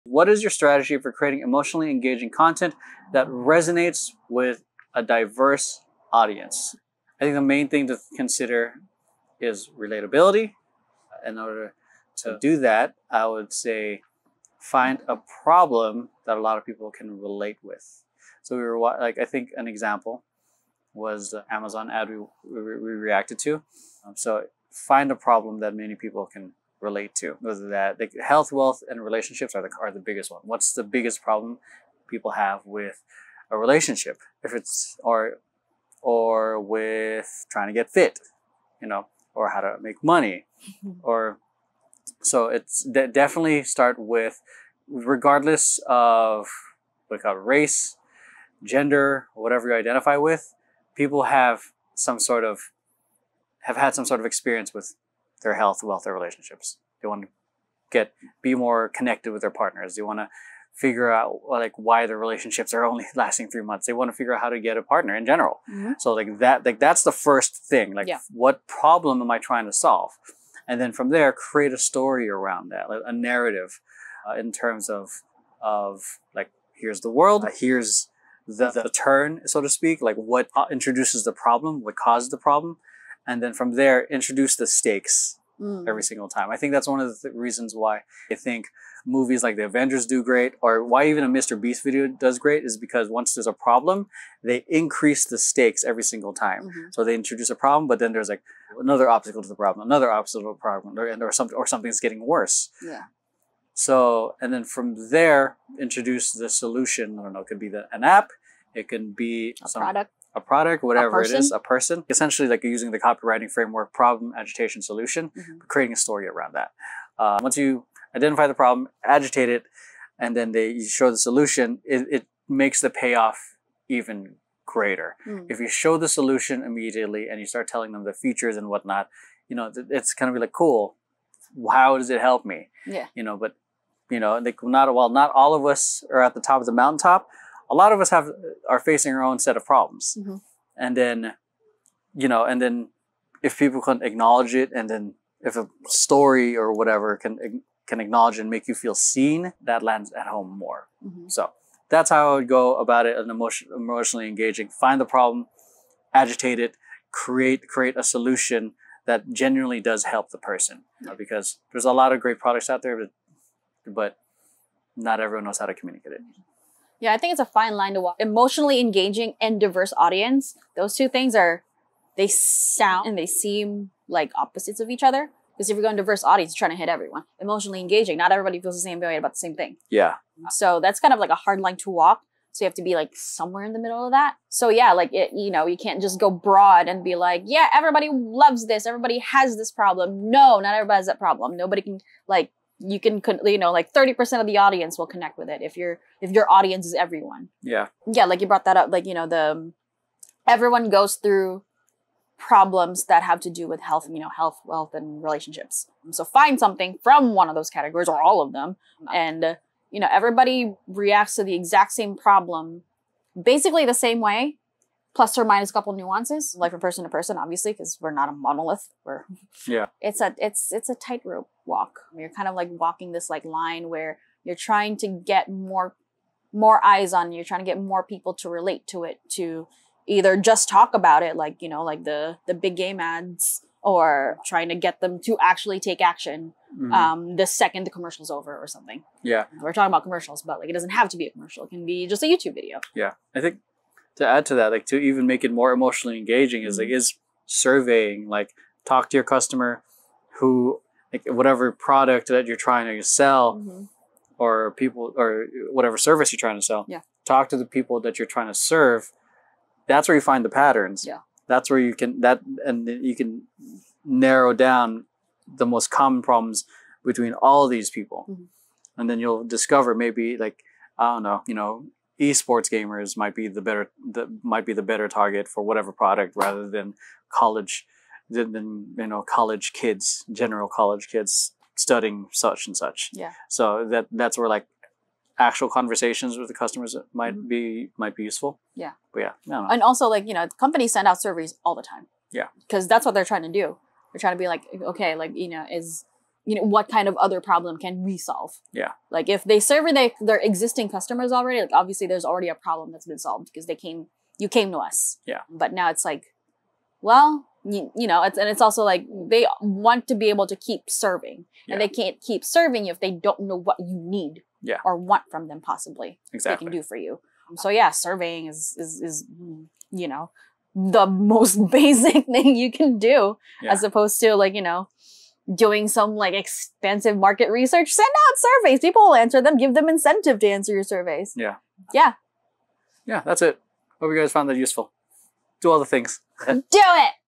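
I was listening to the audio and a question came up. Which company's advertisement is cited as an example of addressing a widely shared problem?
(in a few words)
Amazon.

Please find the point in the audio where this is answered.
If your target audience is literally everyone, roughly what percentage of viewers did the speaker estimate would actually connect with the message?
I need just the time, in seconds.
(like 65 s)
193 s.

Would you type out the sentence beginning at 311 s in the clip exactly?
and they can't keep serving you if they don't know what you need yeah.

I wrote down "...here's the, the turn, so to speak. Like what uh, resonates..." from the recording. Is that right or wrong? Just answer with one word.
wrong.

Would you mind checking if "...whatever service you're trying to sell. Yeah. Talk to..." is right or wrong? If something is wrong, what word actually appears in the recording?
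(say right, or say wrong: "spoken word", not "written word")
right.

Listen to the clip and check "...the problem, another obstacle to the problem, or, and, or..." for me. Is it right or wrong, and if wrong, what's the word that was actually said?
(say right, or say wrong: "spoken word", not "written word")
right.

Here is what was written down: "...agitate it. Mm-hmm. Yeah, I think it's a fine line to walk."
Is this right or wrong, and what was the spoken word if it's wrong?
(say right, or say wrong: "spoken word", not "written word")
wrong: "communicate", not "agitate".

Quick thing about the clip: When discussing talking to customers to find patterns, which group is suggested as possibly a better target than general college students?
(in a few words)
esports gamers.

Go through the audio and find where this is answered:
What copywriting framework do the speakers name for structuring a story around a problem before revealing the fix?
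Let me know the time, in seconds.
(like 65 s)
113 s.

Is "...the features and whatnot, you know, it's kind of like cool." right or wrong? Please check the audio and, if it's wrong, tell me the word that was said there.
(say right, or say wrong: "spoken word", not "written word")
right.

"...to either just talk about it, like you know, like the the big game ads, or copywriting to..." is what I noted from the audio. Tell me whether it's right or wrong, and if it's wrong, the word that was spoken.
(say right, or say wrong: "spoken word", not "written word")
wrong: "trying", not "copywriting".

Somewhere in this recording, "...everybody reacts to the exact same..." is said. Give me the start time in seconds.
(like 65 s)
210 s.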